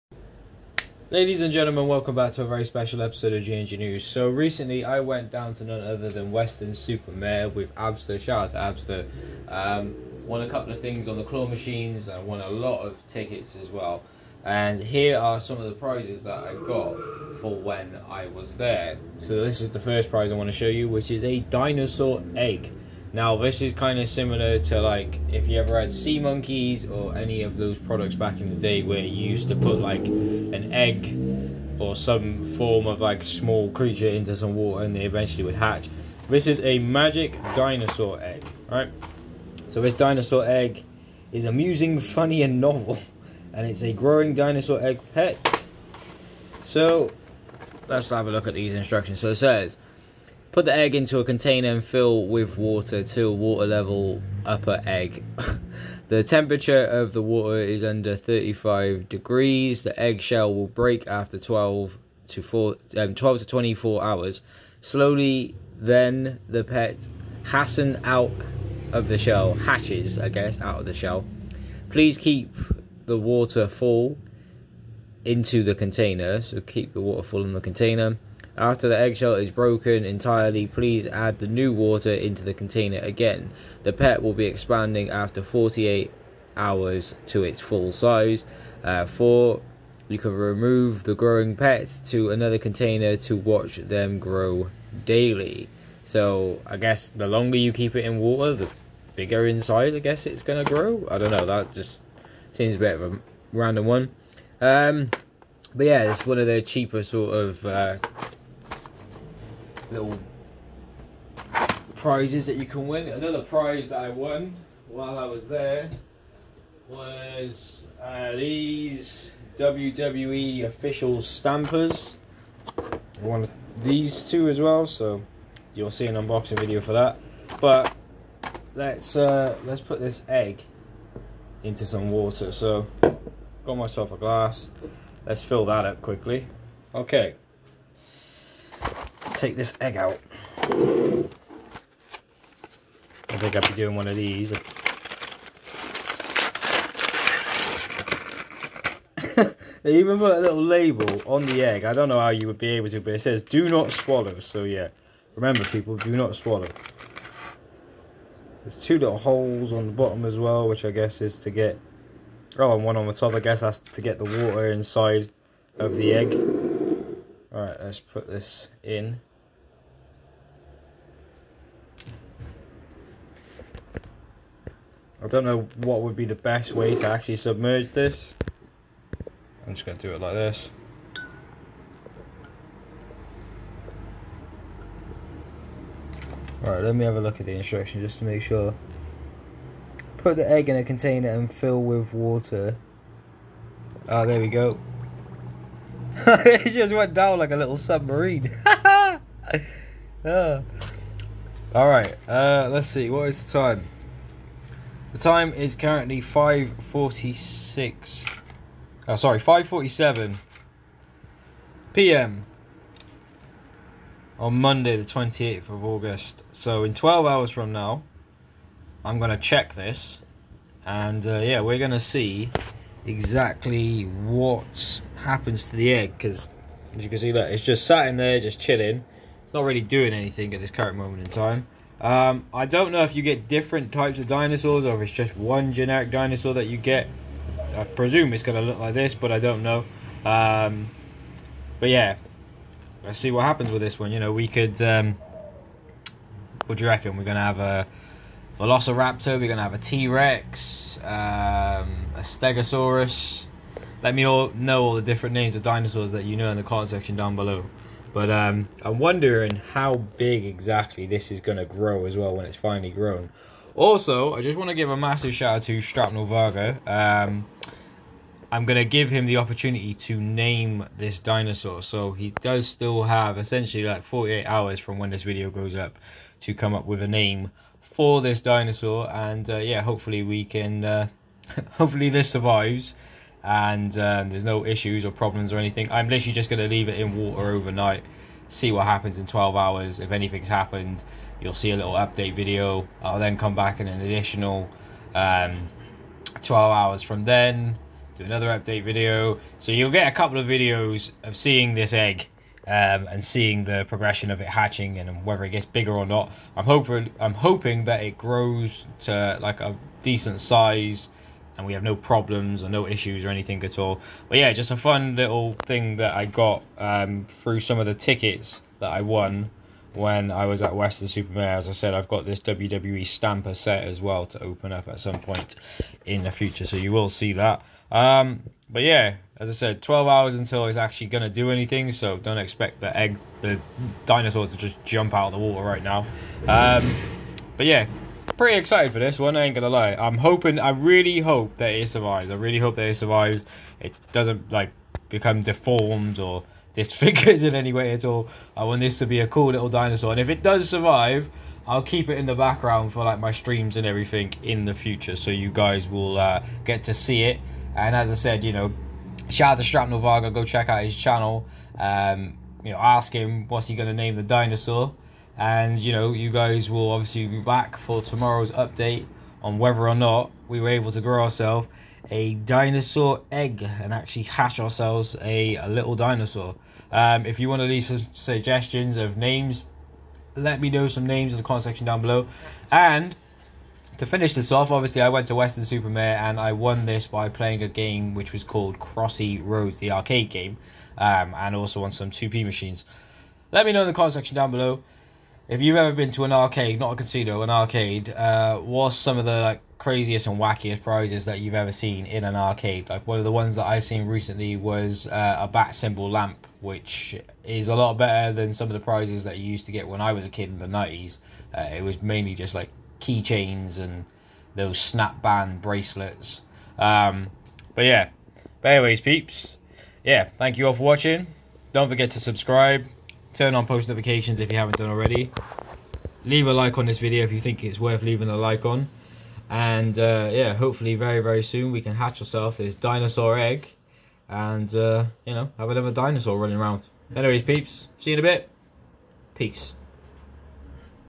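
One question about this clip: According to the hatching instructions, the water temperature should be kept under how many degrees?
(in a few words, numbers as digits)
35.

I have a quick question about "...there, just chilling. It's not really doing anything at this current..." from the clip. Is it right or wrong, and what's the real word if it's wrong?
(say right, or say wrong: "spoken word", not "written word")
right.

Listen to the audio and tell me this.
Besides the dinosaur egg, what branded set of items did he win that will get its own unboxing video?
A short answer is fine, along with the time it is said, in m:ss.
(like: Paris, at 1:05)
WWE official stampers, at 1:59.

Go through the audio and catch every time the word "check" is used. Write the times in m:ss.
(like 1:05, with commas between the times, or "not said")
3:39, 6:00.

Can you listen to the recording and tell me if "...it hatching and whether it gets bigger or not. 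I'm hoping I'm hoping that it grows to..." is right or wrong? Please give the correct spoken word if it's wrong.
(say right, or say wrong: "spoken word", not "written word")
right.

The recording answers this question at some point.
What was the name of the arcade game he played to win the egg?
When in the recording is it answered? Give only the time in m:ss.
6:28.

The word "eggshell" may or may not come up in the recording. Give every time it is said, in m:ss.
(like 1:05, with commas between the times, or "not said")
0:59, 1:18.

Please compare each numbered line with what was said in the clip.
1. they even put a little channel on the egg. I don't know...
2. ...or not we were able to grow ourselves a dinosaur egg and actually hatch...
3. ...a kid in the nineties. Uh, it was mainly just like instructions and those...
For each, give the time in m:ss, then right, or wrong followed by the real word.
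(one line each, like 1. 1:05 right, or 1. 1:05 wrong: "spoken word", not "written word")
1. 2:29 wrong: "label", not "channel"
2. 6:09 right
3. 6:50 wrong: "keychains", not "instructions".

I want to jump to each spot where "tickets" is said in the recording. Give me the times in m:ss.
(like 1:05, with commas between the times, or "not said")
0:13, 5:17.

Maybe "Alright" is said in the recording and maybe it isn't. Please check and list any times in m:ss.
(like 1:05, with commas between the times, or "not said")
2:47, 3:06, 3:21.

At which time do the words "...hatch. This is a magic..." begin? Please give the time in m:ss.
0:35.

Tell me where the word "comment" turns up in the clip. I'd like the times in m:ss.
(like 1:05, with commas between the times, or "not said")
4:16, 6:21, 6:33.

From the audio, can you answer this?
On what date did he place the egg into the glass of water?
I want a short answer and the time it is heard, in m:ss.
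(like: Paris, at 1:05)
28 August, at 3:34.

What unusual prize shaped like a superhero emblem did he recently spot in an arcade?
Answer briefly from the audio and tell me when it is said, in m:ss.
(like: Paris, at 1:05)
Bat symbol lamp, at 6:45.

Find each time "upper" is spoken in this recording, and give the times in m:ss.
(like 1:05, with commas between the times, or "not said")
0:54.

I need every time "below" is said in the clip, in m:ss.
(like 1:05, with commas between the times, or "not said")
4:17, 6:22, 6:34.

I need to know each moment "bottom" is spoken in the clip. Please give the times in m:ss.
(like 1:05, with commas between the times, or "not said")
2:39.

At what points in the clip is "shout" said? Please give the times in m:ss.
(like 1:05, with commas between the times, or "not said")
0:08, 4:25, 5:59.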